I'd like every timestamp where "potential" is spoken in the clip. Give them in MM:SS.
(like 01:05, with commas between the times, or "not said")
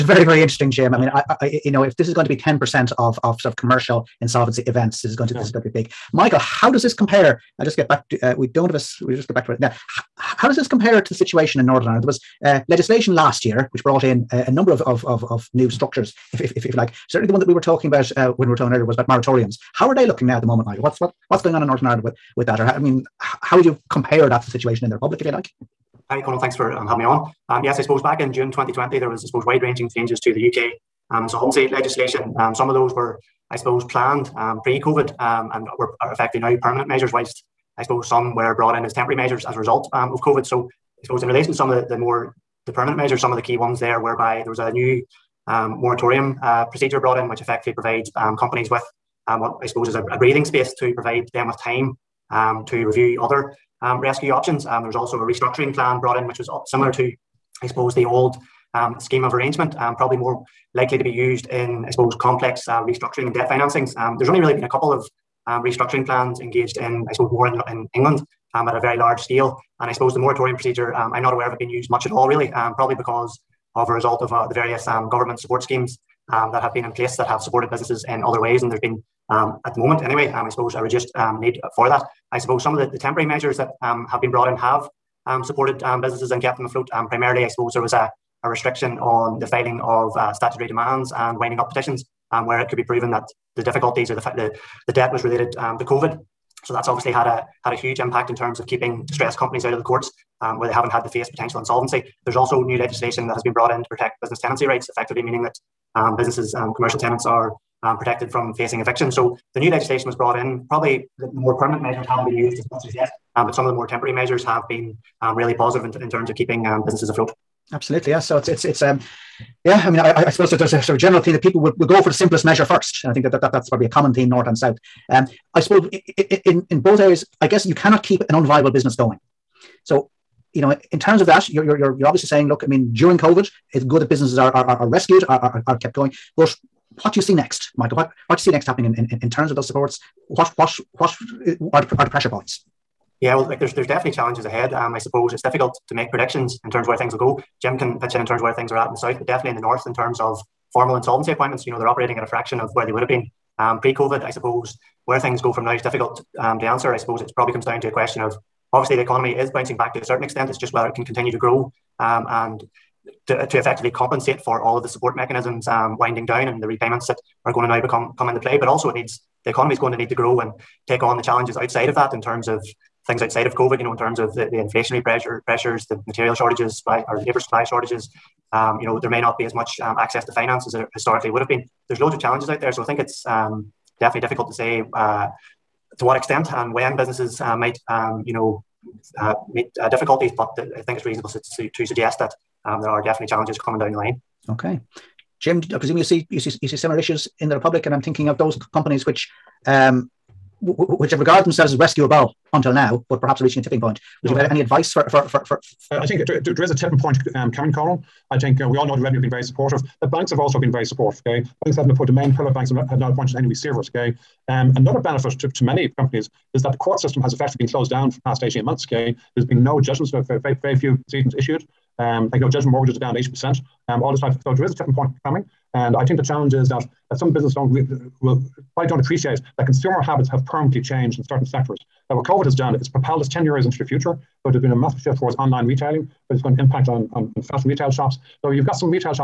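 01:41.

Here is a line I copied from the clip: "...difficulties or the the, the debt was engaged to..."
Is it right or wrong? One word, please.
wrong.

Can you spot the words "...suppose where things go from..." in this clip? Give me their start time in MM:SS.
02:34.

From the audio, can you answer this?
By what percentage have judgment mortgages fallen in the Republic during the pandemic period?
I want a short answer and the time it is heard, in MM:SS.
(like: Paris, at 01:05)
80%, at 03:43.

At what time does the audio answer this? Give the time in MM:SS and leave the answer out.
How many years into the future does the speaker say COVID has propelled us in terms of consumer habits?
03:53.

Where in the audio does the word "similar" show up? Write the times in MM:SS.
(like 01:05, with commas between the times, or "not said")
00:56, 03:16.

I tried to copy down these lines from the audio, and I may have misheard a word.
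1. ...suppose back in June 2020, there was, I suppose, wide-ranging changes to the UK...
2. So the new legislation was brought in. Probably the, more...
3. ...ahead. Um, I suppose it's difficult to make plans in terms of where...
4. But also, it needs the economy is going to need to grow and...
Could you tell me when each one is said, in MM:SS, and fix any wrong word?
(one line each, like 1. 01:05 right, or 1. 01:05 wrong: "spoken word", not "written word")
1. 00:27 right
2. 01:49 right
3. 02:24 wrong: "predictions", not "plans"
4. 02:48 right.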